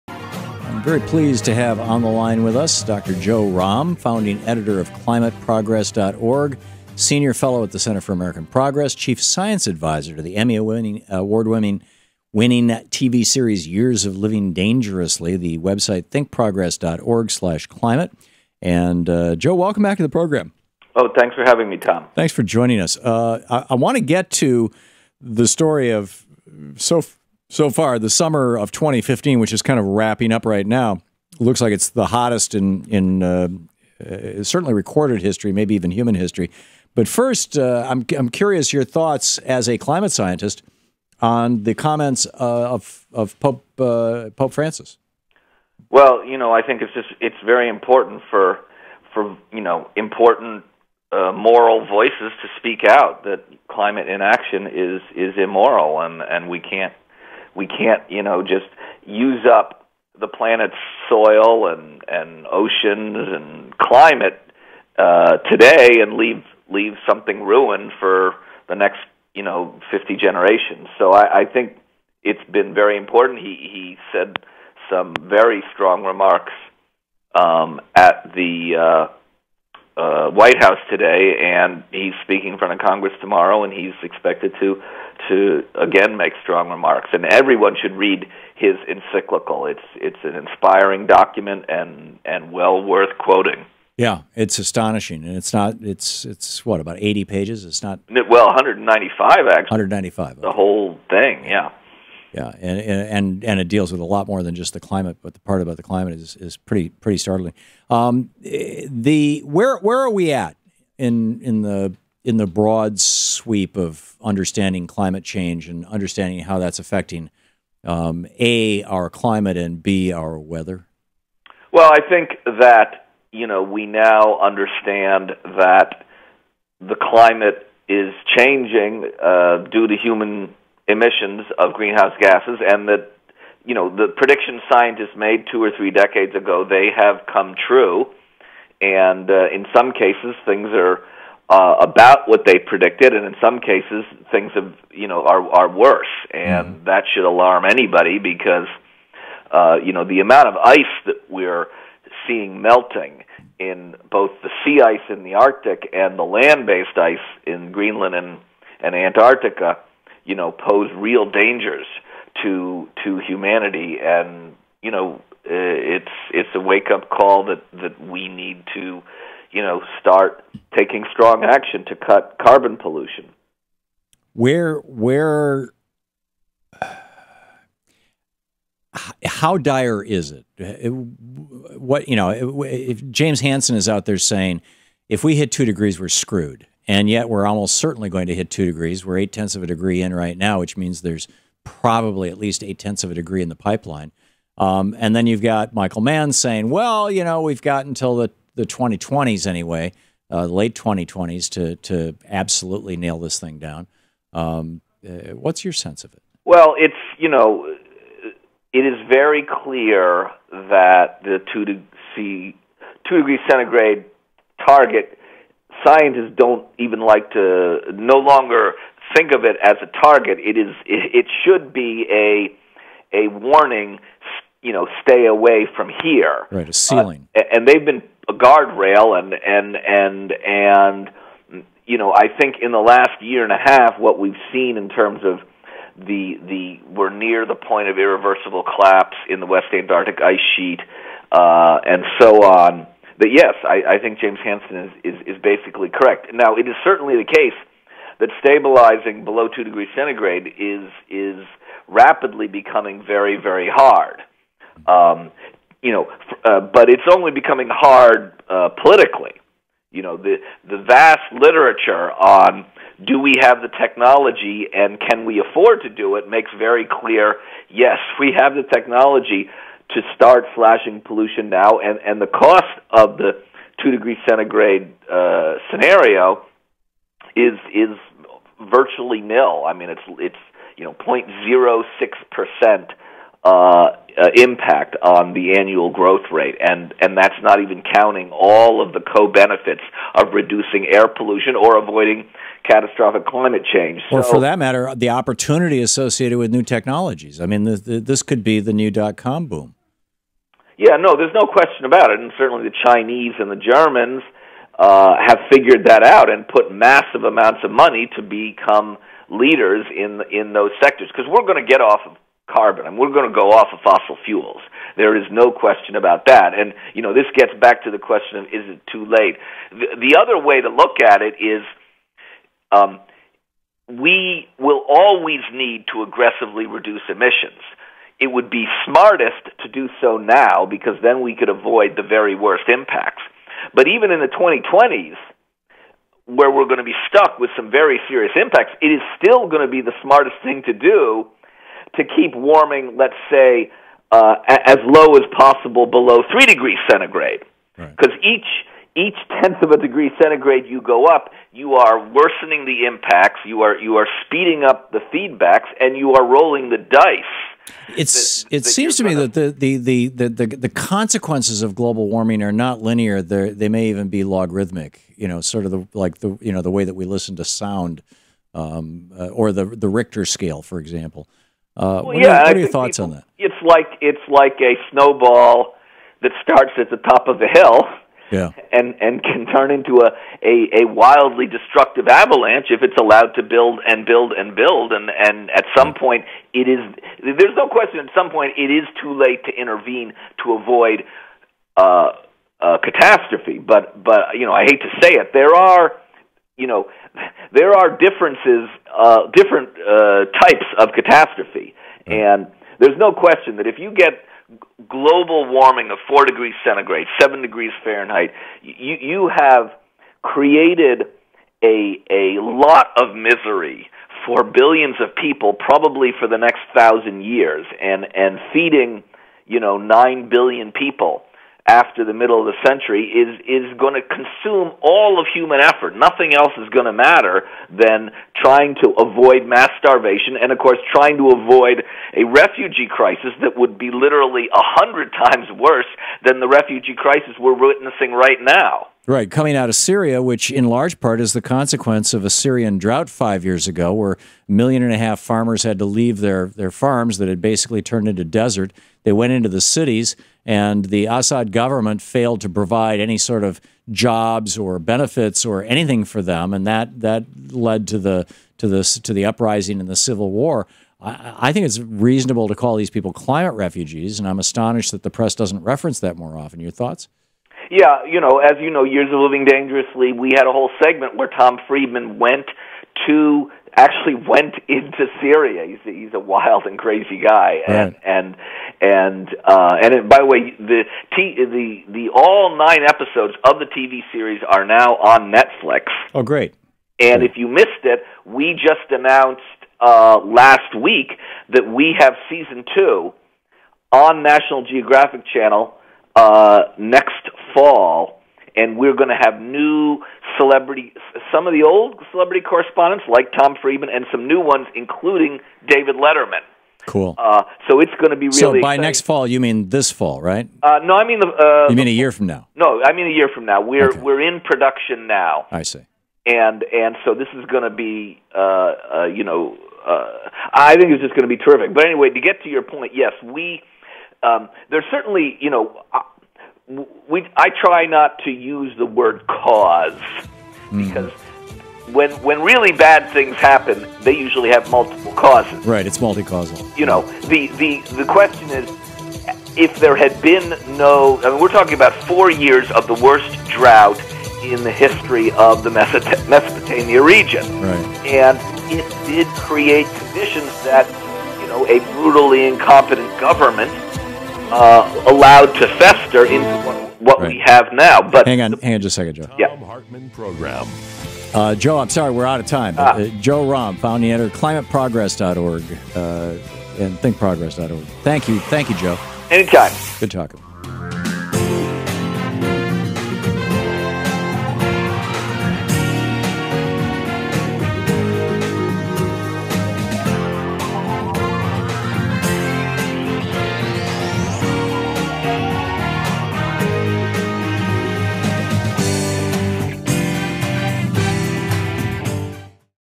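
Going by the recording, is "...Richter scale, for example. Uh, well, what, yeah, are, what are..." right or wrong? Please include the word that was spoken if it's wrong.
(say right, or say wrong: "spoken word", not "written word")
right.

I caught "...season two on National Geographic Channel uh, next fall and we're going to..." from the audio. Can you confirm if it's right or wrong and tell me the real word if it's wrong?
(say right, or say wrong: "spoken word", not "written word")
right.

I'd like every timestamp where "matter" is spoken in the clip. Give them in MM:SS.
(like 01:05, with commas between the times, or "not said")
04:54, 07:06.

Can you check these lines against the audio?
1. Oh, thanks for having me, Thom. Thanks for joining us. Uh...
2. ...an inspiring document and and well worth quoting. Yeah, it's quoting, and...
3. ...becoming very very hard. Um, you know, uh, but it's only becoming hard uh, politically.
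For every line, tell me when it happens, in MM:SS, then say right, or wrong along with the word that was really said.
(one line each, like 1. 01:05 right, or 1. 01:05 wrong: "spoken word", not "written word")
1. 00:20 right
2. 01:30 wrong: "astonishing", not "quoting"
3. 04:12 right.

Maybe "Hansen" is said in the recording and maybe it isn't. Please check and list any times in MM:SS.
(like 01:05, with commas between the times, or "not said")
03:03, 04:04.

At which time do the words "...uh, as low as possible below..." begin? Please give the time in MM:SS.
05:44.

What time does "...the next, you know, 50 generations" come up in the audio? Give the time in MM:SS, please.
01:08.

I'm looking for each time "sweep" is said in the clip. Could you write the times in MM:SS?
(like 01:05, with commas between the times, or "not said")
01:53.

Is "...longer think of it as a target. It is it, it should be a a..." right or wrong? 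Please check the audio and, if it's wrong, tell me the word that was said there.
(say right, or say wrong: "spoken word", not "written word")
right.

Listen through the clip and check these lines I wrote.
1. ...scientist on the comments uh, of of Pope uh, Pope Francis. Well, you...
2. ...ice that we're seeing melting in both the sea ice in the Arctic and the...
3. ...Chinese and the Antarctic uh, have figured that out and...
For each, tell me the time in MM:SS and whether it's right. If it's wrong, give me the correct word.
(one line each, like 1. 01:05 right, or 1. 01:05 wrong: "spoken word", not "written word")
1. 00:40 right
2. 02:30 right
3. 05:02 wrong: "Germans", not "Antarctic".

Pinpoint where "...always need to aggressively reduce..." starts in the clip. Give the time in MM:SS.
05:24.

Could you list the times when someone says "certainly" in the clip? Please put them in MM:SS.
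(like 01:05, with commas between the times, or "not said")
00:34, 03:07, 04:06, 05:02, 08:44.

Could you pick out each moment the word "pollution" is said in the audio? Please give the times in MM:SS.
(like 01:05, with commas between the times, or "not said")
02:52, 04:31, 04:51.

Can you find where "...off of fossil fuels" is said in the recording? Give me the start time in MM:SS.
05:13.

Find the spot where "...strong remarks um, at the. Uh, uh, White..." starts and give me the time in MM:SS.
01:15.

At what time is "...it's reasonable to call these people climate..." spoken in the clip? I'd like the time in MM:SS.
07:41.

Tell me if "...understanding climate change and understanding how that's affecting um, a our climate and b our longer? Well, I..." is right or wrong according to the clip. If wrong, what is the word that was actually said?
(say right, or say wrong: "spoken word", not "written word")
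wrong: "weather", not "longer".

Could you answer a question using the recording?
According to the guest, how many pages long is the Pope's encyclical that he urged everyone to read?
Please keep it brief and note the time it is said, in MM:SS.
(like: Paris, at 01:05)
195, at 01:38.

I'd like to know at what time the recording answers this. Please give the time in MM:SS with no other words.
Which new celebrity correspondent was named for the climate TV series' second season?
08:25.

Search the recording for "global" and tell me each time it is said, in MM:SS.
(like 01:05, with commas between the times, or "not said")
06:01, 06:44.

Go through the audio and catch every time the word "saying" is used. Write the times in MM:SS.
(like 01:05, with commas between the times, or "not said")
03:04, 03:16.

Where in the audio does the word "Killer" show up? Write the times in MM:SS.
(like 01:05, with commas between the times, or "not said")
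not said.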